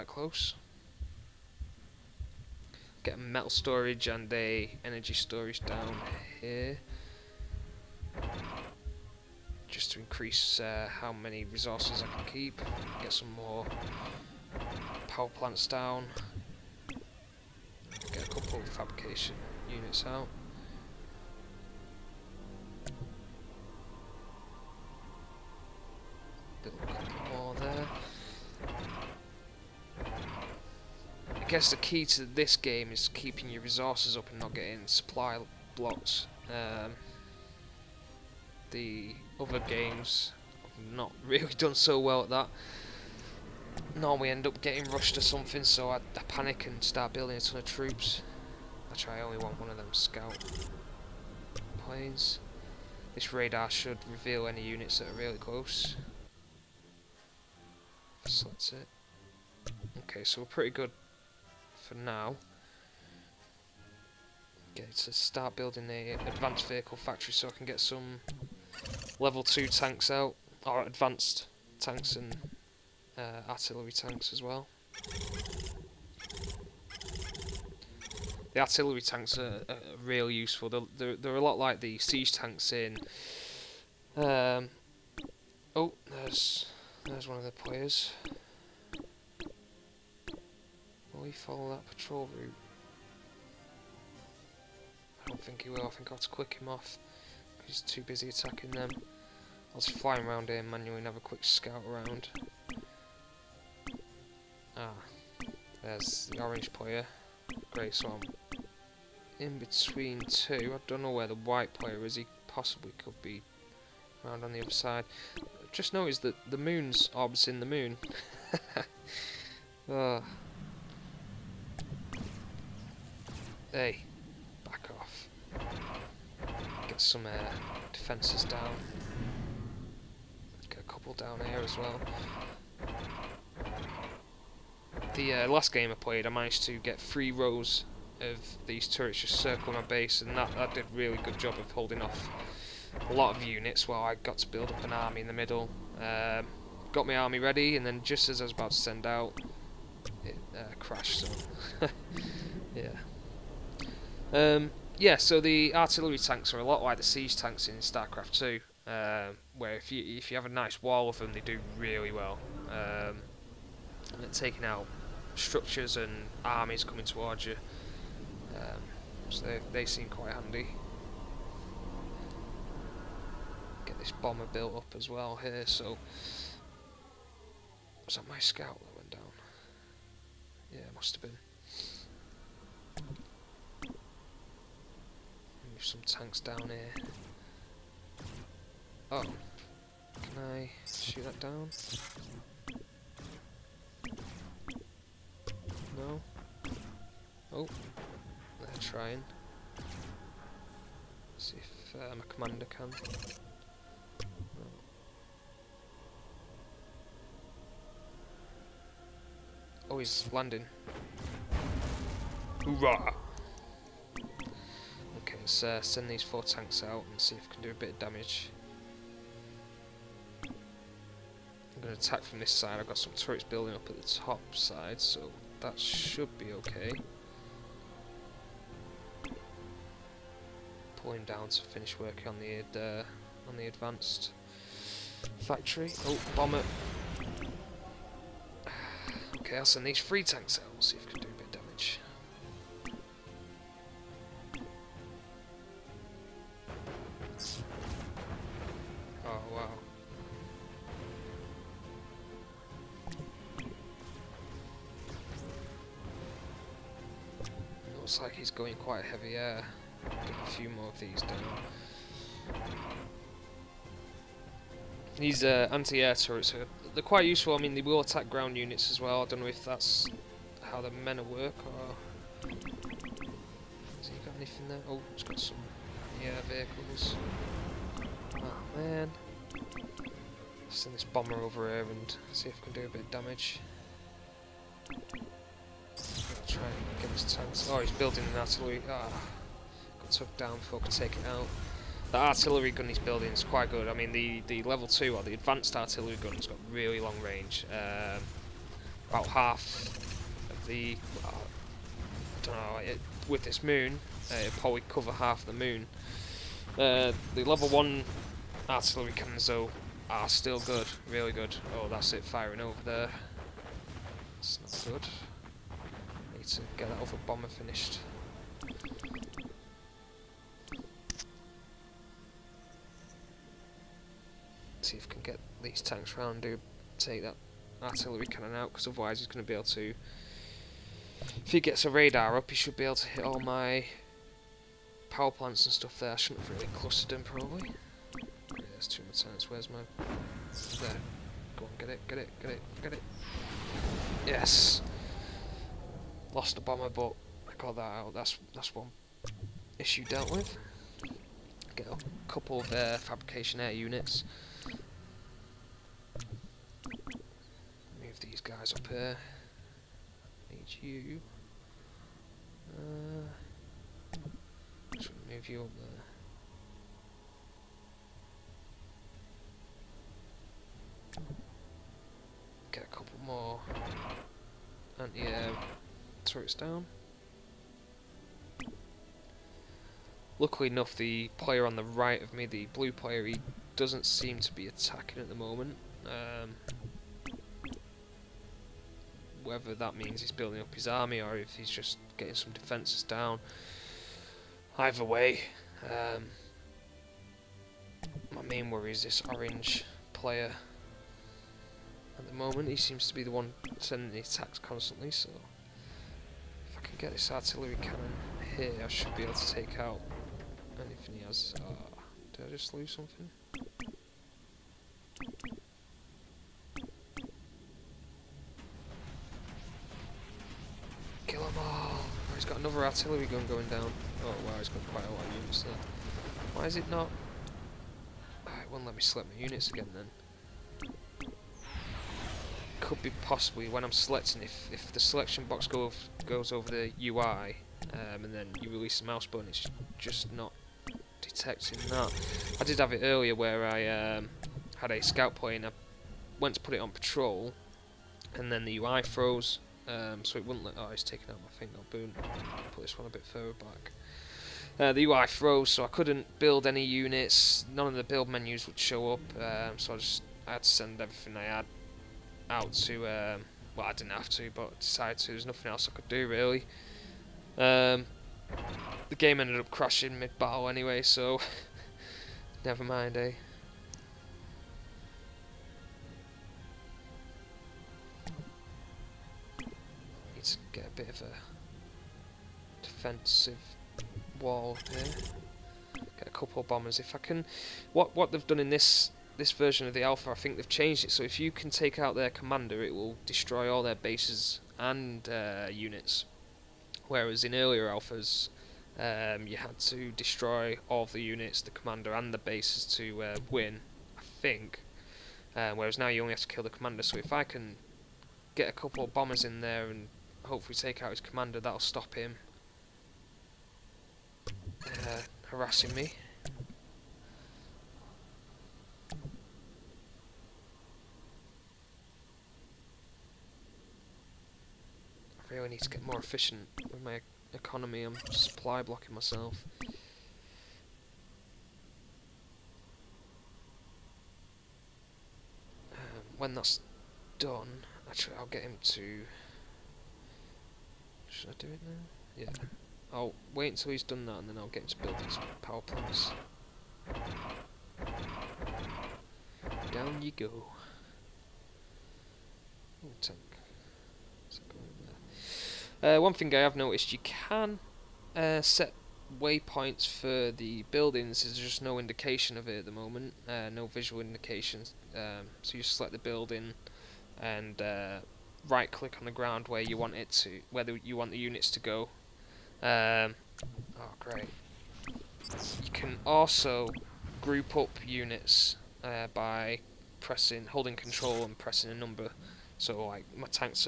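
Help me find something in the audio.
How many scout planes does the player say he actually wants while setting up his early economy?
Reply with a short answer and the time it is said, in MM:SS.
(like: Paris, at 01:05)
1, at 00:49.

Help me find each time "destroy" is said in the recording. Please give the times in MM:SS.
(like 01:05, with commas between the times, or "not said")
08:13, 08:20.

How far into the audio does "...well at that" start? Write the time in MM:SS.
00:41.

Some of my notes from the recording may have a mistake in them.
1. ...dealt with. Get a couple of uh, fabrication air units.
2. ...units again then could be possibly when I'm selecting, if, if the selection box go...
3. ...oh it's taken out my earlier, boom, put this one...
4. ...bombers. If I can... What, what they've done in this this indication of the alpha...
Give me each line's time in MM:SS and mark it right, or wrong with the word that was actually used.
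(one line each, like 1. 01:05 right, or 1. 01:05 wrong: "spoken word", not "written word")
1. 05:50 right
2. 07:09 right
3. 07:30 wrong: "finger", not "earlier"
4. 08:06 wrong: "version", not "indication".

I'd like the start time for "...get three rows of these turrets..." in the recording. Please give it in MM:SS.
02:16.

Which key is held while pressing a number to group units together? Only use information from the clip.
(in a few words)
Control.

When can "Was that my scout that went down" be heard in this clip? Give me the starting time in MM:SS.
02:58.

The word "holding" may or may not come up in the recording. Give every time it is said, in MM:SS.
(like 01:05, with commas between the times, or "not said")
02:21, 09:40.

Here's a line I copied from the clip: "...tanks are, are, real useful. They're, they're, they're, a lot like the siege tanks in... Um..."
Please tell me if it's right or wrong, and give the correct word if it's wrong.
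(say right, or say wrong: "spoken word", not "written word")
right.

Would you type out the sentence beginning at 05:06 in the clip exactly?
Uh, the level 1 artillery cannons, though, are still good.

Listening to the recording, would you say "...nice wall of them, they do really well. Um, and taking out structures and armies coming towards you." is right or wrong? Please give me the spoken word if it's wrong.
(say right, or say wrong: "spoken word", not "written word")
right.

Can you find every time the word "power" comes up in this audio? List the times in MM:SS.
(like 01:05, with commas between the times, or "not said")
00:15, 05:35, 09:05.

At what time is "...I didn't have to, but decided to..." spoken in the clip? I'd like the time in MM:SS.
07:43.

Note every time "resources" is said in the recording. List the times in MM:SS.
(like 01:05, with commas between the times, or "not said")
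00:11, 00:33.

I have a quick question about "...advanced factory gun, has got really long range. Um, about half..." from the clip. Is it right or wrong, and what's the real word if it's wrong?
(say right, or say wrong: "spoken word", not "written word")
wrong: "artillery", not "factory".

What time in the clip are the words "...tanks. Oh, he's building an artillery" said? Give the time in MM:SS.
04:47.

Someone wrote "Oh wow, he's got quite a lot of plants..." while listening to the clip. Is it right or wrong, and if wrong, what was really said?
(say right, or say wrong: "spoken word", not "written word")
wrong: "units", not "plants".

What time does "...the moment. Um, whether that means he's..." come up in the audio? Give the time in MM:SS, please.
06:25.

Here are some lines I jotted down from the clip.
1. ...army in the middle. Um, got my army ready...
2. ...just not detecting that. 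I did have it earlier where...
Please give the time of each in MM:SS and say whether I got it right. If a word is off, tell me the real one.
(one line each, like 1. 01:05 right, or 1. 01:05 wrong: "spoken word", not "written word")
1. 02:24 right
2. 07:19 right.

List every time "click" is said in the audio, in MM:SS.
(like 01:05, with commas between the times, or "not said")
09:28.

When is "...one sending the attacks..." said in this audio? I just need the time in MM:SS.
06:43.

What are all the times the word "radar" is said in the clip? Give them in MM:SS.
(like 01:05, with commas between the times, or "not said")
00:53, 05:31.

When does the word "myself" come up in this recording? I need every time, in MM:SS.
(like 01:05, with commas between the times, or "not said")
08:49.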